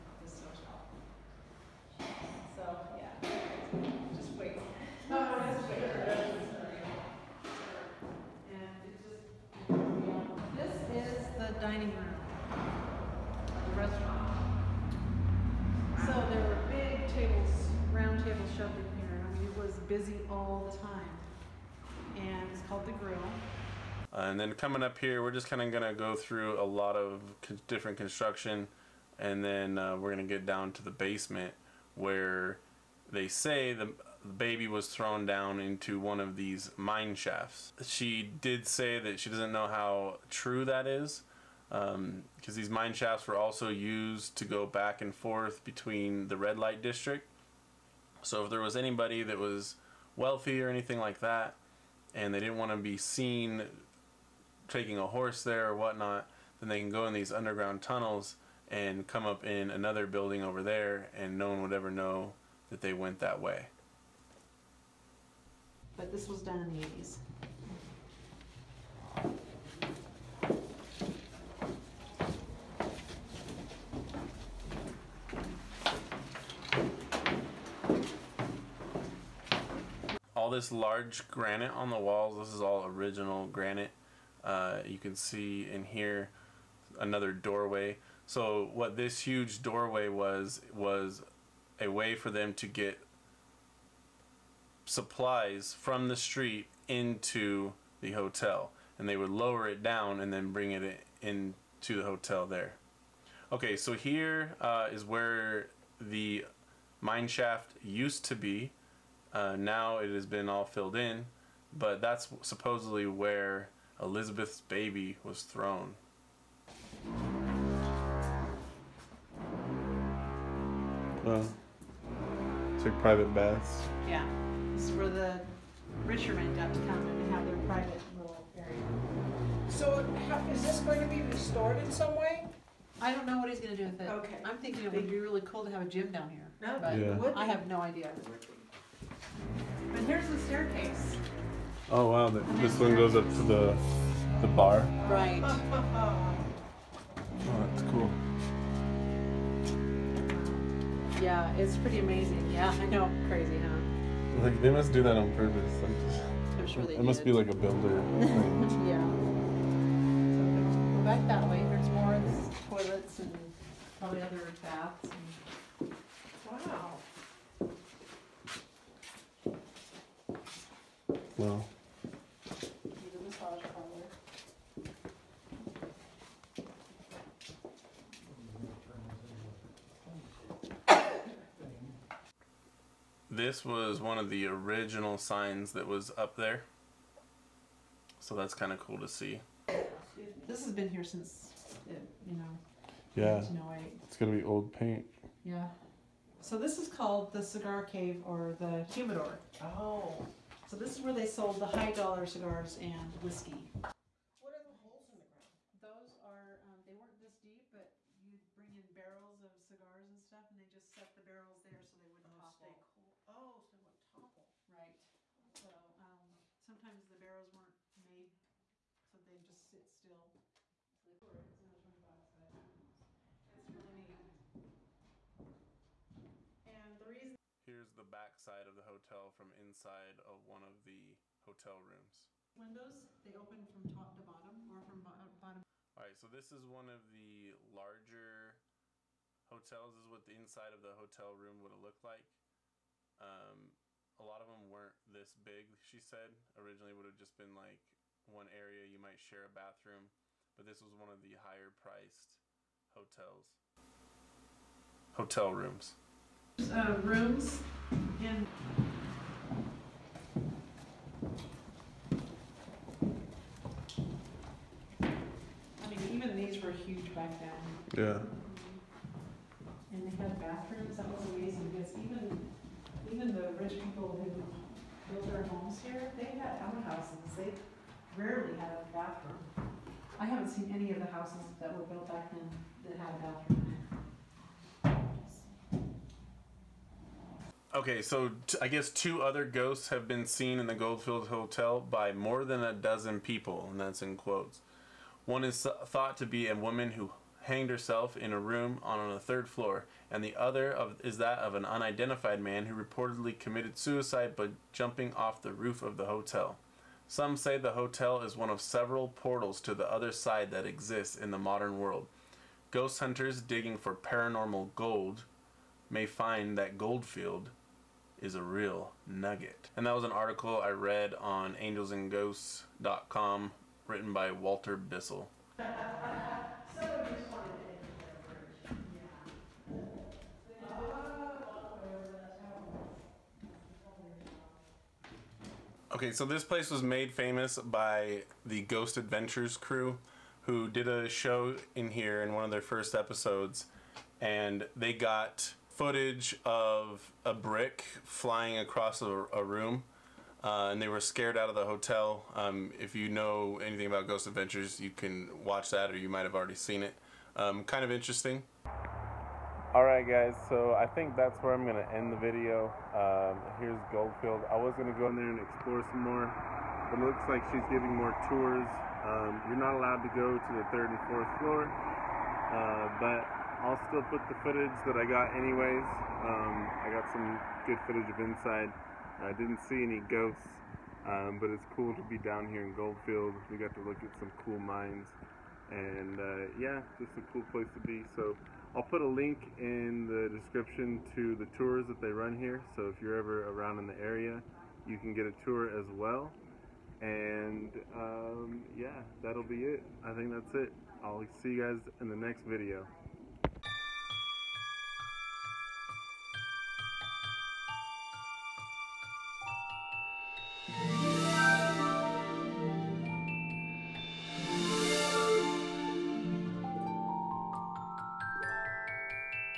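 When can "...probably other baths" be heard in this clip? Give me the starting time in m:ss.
2:43.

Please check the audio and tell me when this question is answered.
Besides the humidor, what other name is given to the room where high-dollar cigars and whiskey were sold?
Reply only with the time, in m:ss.
3:17.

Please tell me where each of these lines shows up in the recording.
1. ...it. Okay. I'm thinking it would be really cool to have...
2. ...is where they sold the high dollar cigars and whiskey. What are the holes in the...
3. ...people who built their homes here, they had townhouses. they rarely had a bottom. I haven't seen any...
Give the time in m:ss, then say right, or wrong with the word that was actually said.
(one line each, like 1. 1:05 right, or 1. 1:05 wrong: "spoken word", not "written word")
1. 2:13 right
2. 3:20 right
3. 4:33 wrong: "bathroom", not "bottom".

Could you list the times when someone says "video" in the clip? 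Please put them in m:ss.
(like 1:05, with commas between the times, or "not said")
6:02, 6:42.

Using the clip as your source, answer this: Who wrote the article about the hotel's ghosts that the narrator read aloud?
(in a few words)
Walter Bissell.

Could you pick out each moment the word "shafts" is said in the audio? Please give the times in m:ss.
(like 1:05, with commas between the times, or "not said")
0:37, 0:42, 1:47.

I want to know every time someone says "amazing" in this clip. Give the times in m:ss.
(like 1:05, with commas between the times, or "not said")
2:31, 4:31.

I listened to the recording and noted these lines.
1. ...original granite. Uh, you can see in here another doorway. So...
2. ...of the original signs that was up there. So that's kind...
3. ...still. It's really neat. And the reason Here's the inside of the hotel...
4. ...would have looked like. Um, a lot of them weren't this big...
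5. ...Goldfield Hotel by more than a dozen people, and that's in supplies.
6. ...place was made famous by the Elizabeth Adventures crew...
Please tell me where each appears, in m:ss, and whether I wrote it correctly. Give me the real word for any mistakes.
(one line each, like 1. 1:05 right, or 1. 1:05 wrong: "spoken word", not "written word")
1. 1:22 right
2. 3:04 right
3. 3:39 wrong: "backside", not "inside"
4. 4:01 right
5. 4:50 wrong: "quotes", not "supplies"
6. 5:36 wrong: "Ghost", not "Elizabeth".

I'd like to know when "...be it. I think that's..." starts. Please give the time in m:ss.
6:39.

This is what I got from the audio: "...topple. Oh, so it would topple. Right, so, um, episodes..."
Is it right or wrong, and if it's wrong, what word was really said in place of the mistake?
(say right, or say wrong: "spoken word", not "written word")
wrong: "sometimes", not "episodes".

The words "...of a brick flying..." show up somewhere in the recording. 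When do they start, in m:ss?
5:46.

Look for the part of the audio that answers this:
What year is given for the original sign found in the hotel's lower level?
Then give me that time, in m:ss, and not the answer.
3:13.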